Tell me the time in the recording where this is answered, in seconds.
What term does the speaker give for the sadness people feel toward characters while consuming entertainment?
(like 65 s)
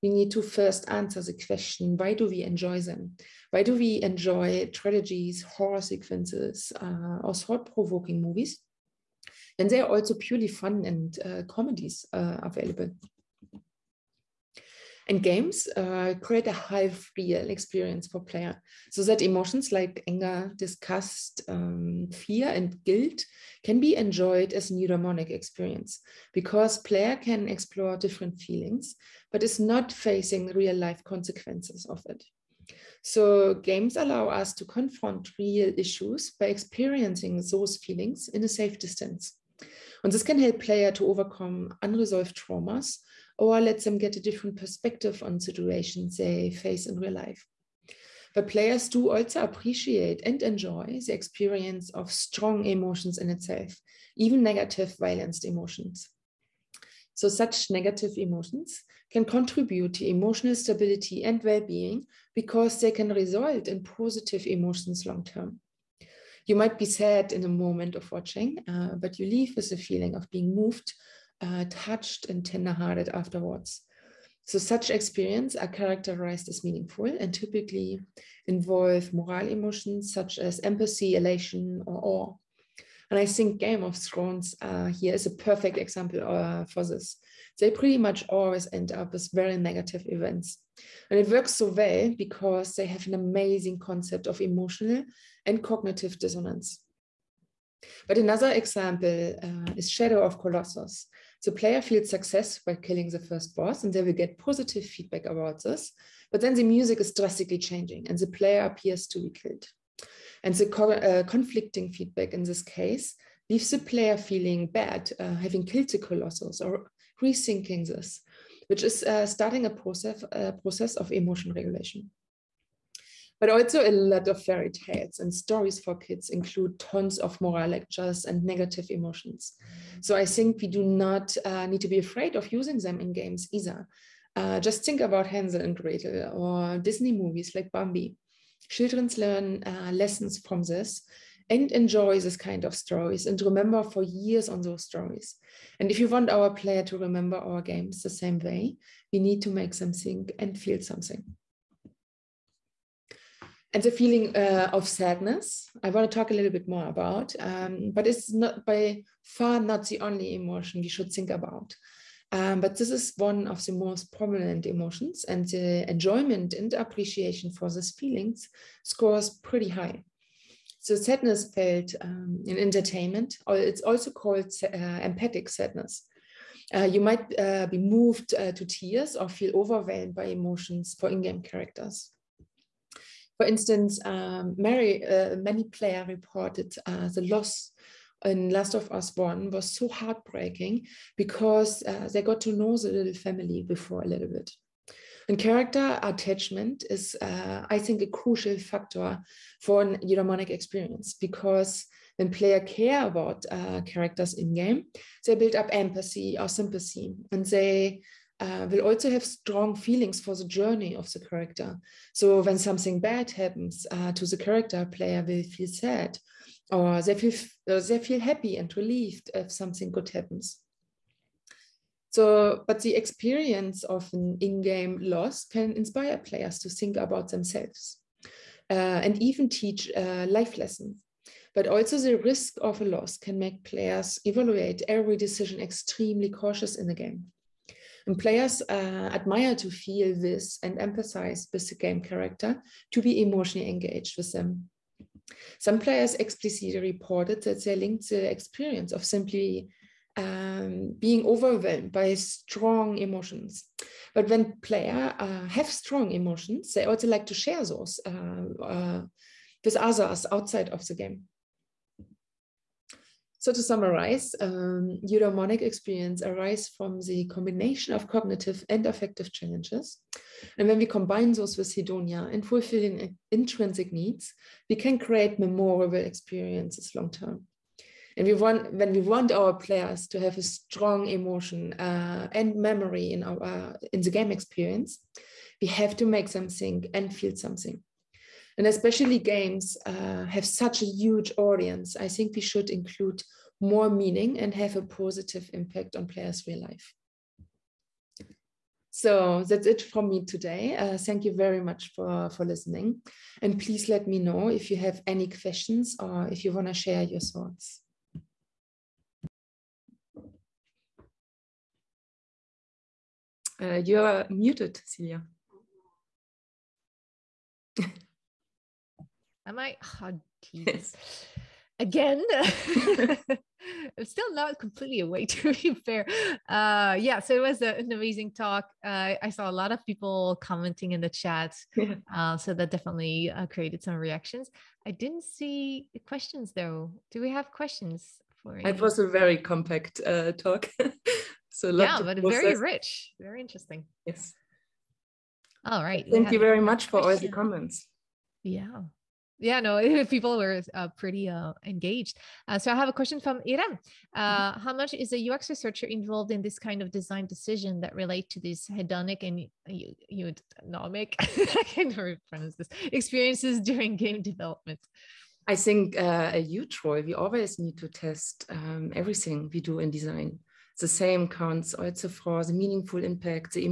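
174 s.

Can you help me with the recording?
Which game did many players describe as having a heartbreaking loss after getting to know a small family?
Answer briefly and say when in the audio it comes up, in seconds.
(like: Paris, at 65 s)
Last of Us 1, at 188 s.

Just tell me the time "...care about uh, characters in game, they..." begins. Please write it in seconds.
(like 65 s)
202 s.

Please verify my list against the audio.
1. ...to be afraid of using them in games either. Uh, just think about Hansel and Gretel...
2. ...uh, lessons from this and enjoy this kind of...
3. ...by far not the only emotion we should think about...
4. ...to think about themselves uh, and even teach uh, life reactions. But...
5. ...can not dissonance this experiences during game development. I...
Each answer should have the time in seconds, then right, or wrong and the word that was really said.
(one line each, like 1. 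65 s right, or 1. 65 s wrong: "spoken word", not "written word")
1. 131 s right
2. 139 s right
3. 158 s right
4. 226 s wrong: "lessons", not "reactions"
5. 361 s wrong: "pronounce", not "dissonance".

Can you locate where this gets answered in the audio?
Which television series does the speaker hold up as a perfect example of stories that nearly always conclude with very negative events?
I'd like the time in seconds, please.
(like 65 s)
83 s.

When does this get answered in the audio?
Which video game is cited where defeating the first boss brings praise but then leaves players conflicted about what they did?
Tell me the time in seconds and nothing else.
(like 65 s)
99 s.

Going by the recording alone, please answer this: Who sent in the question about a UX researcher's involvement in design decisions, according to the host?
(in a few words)
Iran.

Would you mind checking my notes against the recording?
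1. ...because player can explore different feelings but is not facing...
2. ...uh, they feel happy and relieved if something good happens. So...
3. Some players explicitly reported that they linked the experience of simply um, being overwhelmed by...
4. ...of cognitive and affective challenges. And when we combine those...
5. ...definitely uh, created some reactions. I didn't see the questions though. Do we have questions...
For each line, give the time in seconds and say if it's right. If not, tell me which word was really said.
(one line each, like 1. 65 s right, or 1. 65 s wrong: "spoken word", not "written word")
1. 26 s right
2. 217 s right
3. 245 s right
4. 267 s right
5. 332 s right.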